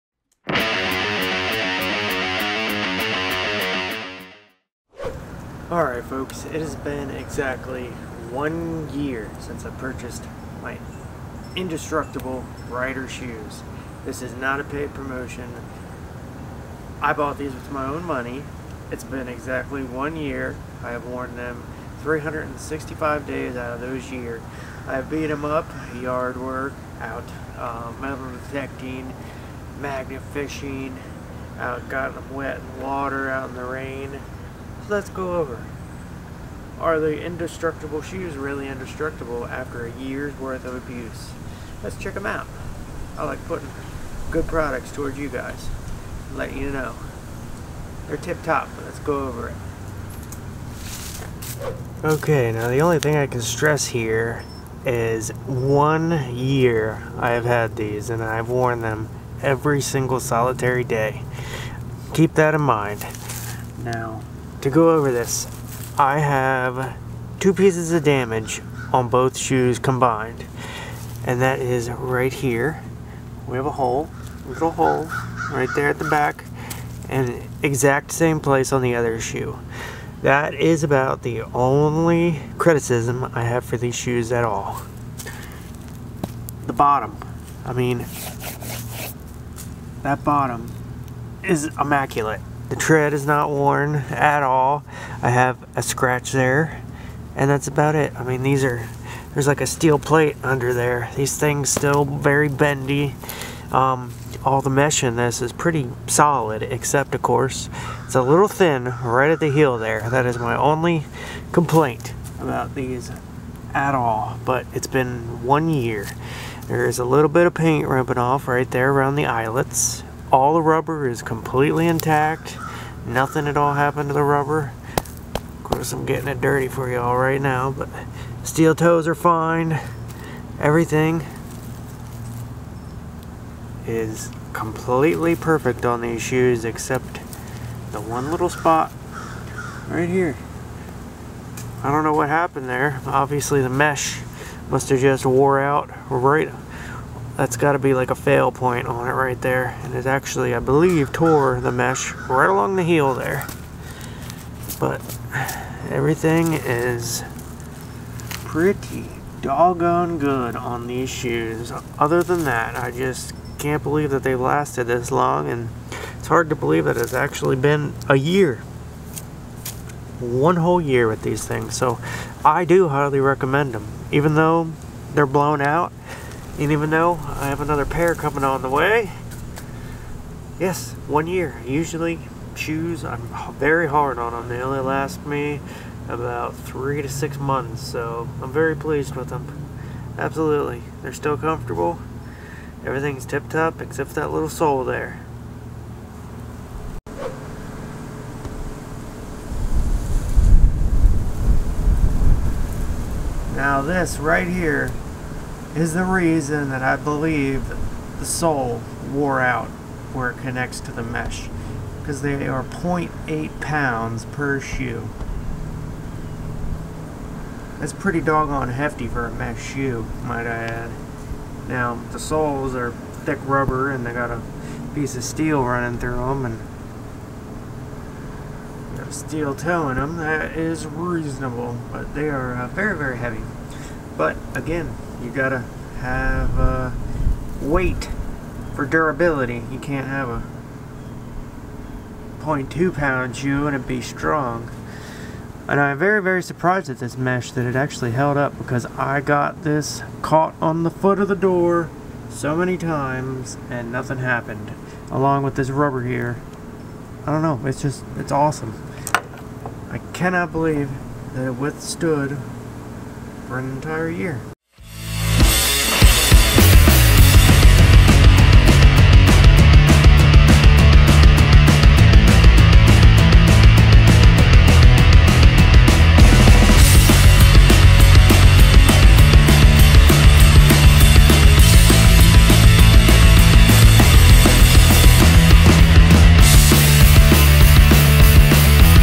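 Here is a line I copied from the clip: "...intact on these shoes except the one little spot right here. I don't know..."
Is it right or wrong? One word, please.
wrong.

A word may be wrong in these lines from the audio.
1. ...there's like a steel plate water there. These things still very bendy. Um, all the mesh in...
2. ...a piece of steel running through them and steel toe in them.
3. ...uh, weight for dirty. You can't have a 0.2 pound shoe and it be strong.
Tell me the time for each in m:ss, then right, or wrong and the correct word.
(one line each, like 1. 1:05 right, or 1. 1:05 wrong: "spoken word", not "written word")
1. 1:39 wrong: "under", not "water"
2. 3:44 right
3. 3:56 wrong: "durability", not "dirty".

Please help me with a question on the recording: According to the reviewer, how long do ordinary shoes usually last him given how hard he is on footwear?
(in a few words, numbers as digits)
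3 to 6 months.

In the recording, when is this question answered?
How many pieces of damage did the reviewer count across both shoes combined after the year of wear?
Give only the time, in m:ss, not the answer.
1:07.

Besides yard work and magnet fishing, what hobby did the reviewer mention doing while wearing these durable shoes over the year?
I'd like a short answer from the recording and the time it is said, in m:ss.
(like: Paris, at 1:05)
metal detecting, at 0:28.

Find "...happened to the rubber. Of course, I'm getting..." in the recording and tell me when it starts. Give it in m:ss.
2:03.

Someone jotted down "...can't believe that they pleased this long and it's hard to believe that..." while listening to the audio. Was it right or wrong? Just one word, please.
wrong.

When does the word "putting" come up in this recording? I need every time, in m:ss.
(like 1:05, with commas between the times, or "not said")
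0:43.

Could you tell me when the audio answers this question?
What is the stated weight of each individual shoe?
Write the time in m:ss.
3:32.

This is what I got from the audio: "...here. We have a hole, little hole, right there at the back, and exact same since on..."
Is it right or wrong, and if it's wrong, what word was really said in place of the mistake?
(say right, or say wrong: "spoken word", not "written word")
wrong: "place", not "since".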